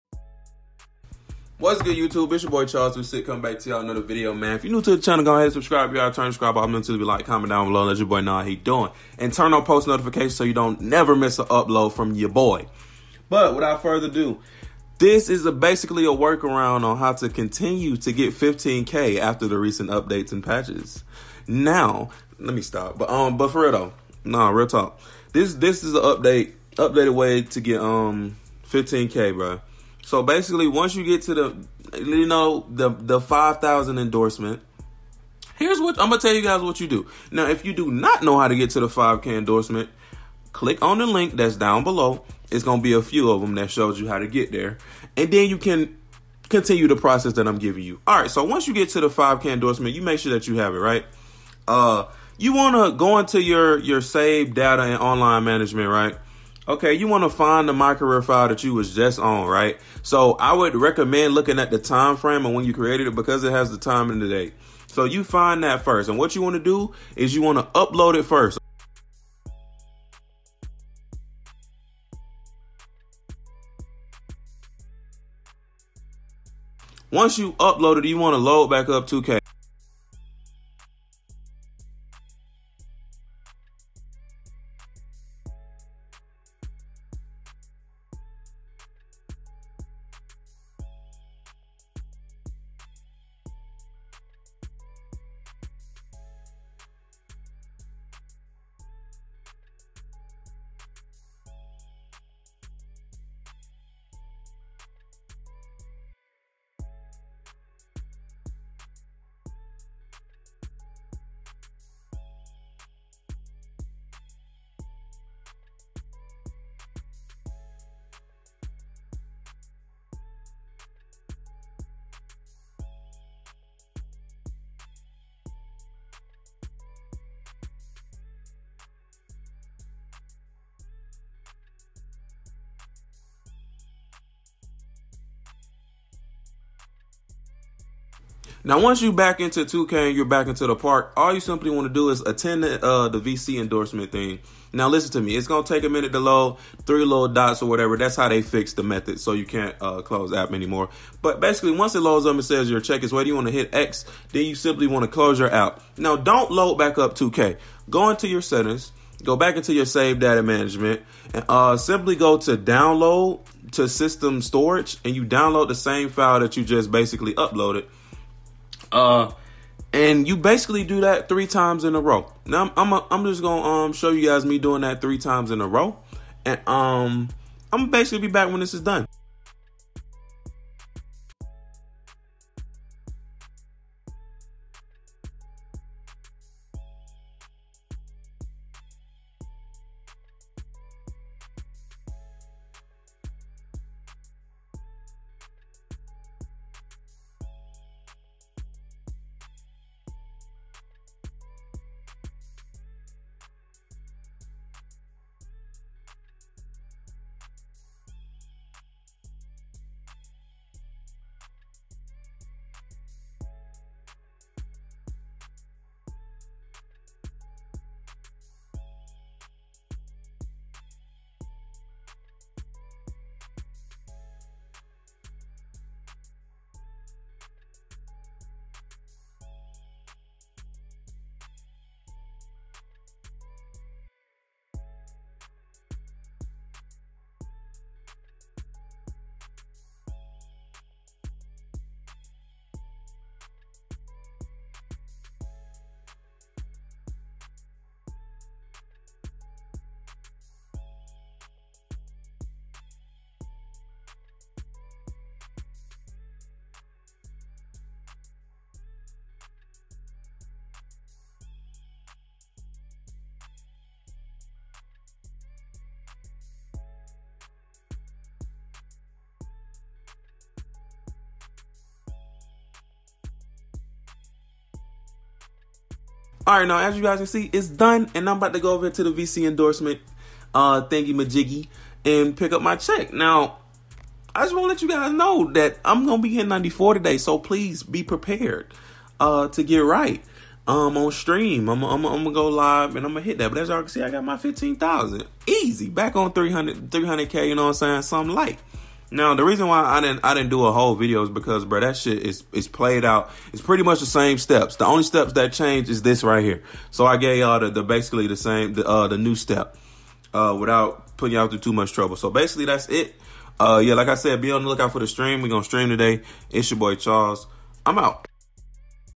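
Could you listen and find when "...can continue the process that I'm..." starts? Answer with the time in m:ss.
0:45.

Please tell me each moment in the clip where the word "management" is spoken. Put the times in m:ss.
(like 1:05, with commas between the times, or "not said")
0:55, 2:40.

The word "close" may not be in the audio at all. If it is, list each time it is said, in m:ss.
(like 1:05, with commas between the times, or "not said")
2:30, 2:35.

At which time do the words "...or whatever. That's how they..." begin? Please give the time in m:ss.
2:27.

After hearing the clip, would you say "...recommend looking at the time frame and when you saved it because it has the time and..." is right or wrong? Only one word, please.
wrong.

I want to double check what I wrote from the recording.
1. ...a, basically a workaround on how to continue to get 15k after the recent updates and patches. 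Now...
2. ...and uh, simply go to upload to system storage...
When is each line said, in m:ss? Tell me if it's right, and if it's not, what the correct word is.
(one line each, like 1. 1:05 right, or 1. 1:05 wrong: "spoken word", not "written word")
1. 0:15 right
2. 2:41 wrong: "download", not "upload".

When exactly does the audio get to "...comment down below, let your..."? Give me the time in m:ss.
0:07.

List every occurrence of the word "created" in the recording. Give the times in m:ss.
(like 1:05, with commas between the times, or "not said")
1:02.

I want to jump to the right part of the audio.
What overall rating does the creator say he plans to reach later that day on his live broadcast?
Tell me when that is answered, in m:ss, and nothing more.
4:46.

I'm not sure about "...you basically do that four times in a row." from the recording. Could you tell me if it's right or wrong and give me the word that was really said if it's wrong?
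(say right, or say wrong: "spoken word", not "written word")
wrong: "three", not "four".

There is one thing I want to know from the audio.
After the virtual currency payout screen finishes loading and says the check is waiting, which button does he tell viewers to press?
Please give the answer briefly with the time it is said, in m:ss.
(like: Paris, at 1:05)
X, at 2:33.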